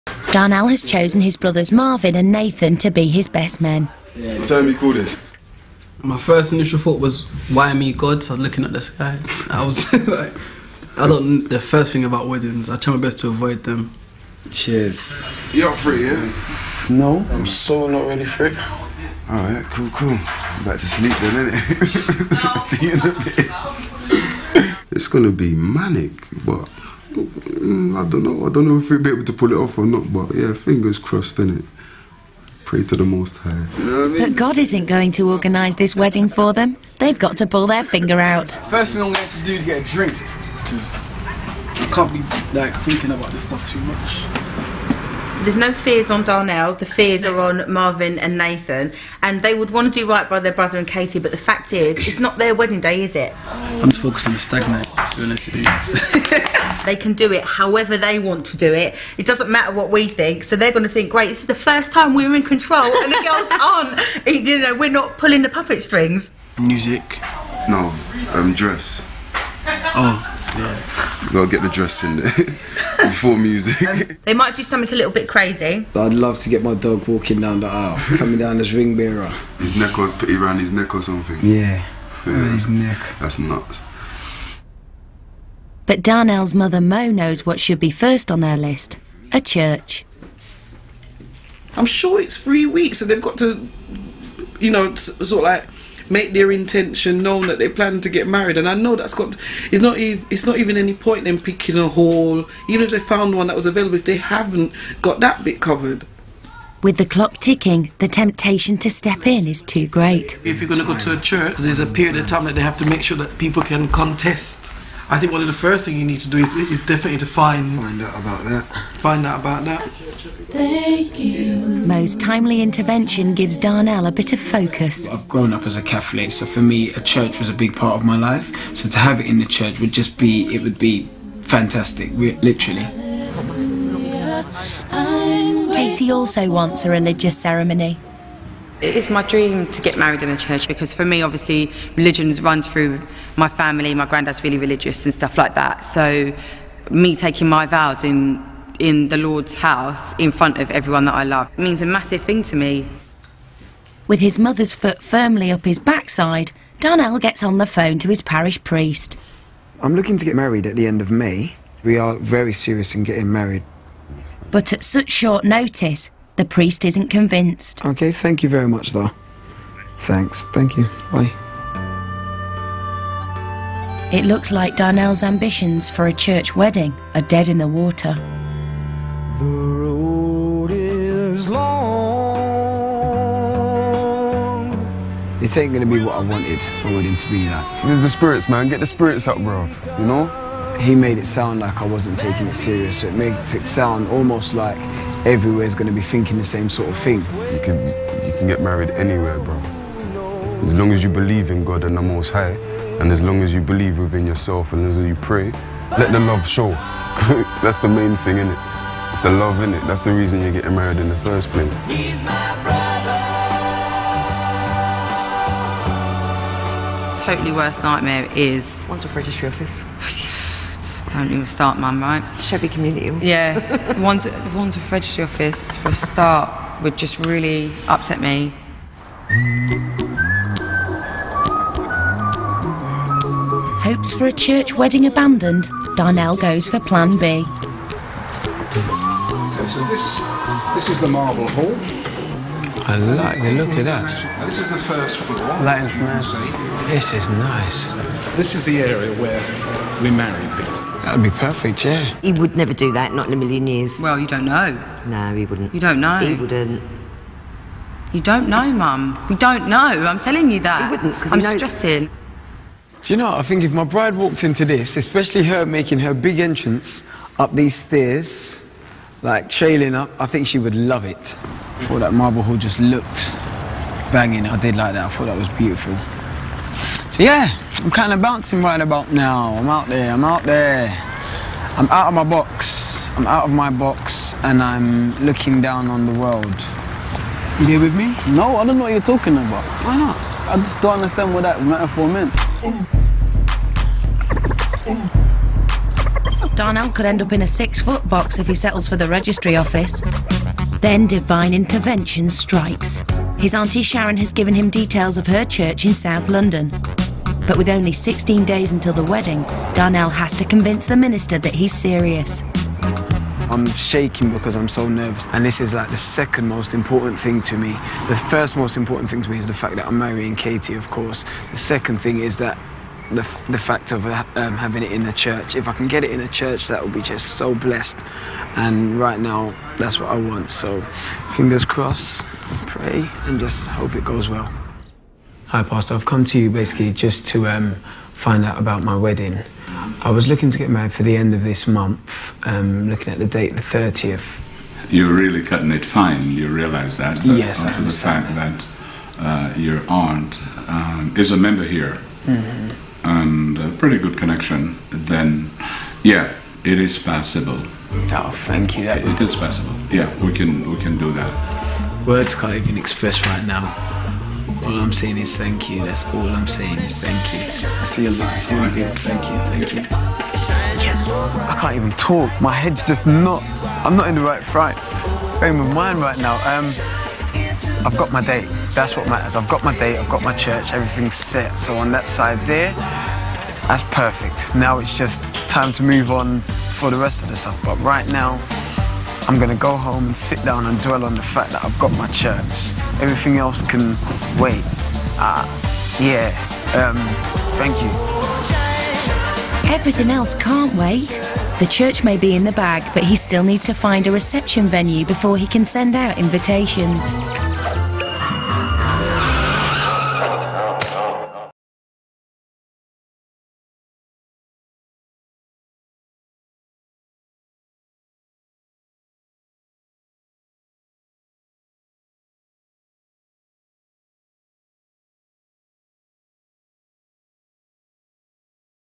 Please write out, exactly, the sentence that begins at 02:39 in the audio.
I'm looking to get married at the end of May.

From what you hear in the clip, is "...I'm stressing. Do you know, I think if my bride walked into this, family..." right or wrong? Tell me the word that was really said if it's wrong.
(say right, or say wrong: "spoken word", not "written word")
wrong: "especially", not "family".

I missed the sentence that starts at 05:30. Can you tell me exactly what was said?
So fingers crossed, pray, and just hope it goes well.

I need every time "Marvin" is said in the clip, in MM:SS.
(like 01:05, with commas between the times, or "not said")
00:01, 00:47.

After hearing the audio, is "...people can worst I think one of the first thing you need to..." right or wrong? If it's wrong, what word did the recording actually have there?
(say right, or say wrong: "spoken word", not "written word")
wrong: "contest", not "worst".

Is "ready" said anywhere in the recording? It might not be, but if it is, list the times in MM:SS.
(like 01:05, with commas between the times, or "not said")
00:18.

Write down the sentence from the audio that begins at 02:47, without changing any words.
Okay, thank you very much, though.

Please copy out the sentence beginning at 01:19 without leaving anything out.
His neck was put around his neck or something.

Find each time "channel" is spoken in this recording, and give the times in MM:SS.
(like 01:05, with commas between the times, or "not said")
not said.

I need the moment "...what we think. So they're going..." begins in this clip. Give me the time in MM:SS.
00:59.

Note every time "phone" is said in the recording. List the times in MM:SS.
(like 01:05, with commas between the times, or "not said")
02:37.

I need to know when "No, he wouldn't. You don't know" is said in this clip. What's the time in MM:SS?
04:15.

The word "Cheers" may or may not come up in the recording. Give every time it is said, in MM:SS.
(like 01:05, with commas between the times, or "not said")
00:14.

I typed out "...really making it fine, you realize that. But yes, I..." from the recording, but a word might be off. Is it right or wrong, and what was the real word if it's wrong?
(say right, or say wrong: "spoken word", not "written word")
wrong: "cutting", not "making".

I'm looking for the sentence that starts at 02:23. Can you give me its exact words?
My granddad's really religious and stuff like that.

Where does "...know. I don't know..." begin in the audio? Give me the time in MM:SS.
00:28.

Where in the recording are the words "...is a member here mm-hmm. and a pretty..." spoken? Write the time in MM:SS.
05:51.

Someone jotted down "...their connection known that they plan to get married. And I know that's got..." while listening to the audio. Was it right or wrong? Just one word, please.
wrong.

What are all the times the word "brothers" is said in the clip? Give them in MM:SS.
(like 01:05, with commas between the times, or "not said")
00:01, 00:50.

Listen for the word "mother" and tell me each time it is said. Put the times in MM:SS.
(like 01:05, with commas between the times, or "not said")
01:26, 02:34.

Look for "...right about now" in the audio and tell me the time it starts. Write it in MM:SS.
04:38.